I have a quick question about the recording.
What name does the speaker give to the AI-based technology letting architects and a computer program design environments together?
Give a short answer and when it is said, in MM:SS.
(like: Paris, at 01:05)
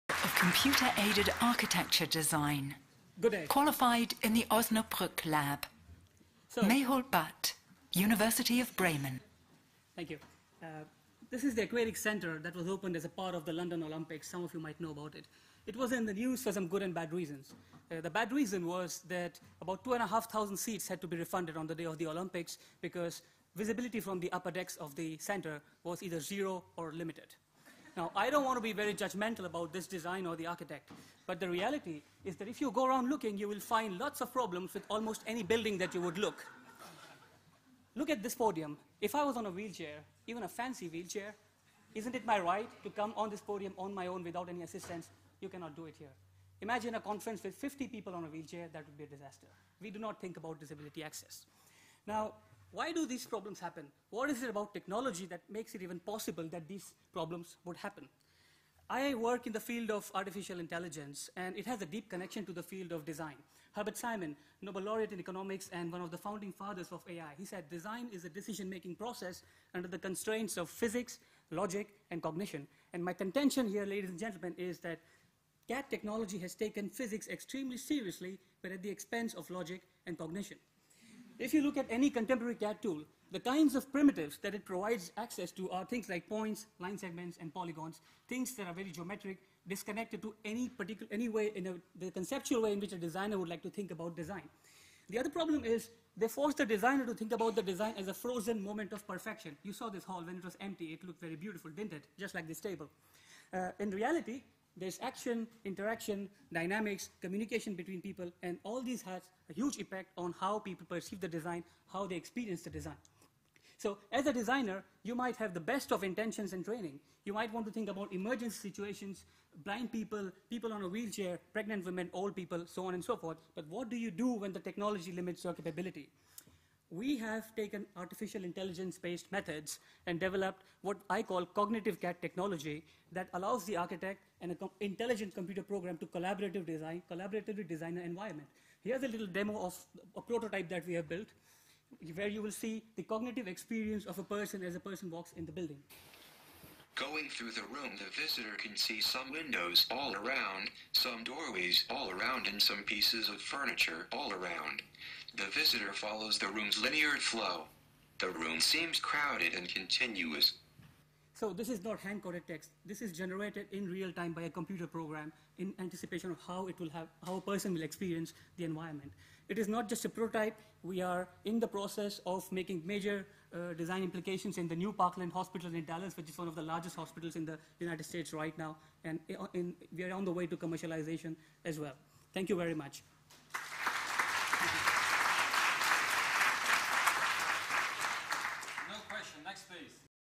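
cognitive CAD technology, at 02:11.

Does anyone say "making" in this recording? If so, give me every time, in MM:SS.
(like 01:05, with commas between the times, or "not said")
01:08, 02:52.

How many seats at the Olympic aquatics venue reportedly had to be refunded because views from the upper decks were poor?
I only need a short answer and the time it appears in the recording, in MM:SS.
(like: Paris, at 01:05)
2,500, at 00:19.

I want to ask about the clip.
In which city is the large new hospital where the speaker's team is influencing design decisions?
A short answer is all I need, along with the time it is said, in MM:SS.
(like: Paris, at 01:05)
Dallas, at 02:55.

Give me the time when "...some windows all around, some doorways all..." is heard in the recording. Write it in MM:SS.
02:29.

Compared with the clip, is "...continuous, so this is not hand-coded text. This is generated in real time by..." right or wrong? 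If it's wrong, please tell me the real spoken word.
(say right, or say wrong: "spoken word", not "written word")
right.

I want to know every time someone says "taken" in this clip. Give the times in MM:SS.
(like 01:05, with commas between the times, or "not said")
01:16, 02:07.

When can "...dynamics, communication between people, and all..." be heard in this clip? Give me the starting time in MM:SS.
01:46.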